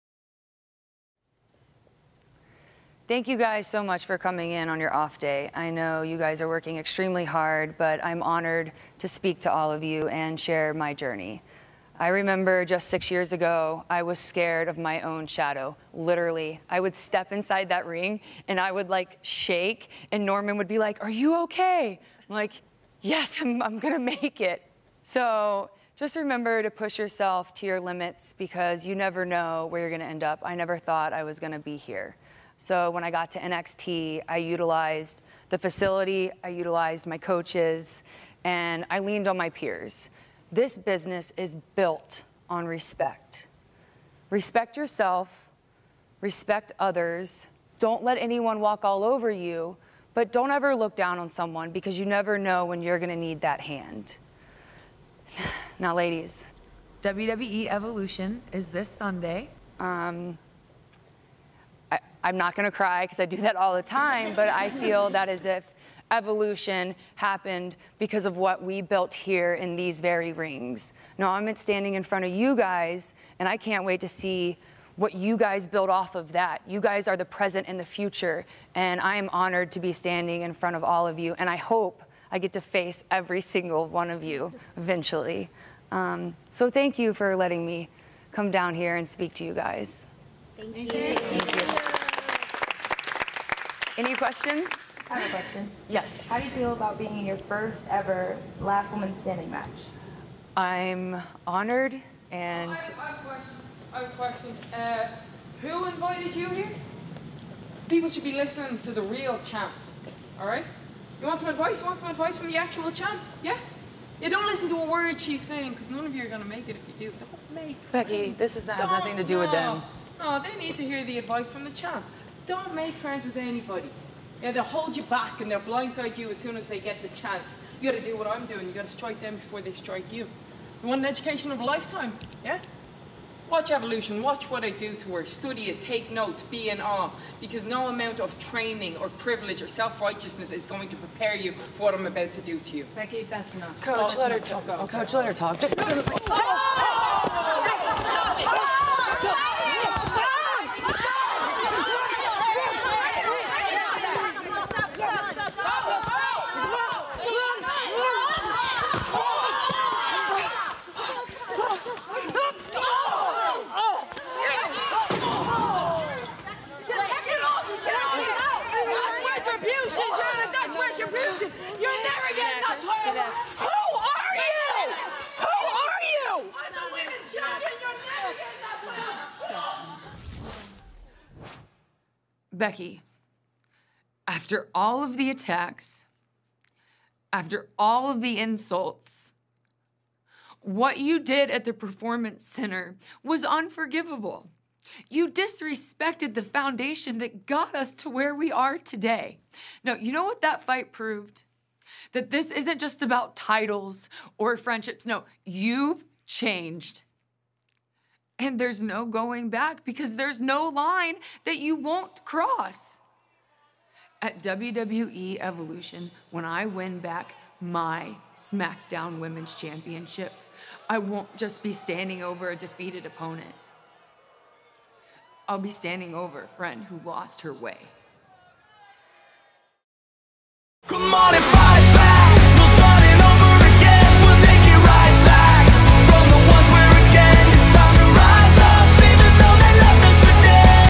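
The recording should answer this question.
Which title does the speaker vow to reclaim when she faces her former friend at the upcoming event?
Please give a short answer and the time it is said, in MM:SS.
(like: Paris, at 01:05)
SmackDown Women's Championship, at 03:38.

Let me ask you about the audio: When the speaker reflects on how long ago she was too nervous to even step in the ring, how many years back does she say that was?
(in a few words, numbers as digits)
6.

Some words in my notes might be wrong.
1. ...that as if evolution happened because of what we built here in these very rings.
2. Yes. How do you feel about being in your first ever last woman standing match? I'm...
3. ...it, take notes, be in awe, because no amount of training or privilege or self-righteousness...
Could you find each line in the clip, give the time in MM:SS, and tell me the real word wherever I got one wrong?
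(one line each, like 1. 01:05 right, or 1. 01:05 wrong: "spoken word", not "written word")
1. 01:05 right
2. 01:35 right
3. 02:15 right.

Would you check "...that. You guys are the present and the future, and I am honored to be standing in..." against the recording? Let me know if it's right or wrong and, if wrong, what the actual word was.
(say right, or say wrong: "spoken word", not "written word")
right.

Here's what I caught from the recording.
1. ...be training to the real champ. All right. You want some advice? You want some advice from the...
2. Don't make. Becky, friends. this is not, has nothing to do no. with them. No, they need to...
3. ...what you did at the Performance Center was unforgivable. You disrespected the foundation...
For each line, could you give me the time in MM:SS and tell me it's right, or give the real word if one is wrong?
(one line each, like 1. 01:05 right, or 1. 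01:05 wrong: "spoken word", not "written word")
1. 01:48 wrong: "listening", not "training"
2. 01:57 right
3. 03:10 right.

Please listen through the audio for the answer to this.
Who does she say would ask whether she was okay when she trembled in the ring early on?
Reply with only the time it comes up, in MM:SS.
00:20.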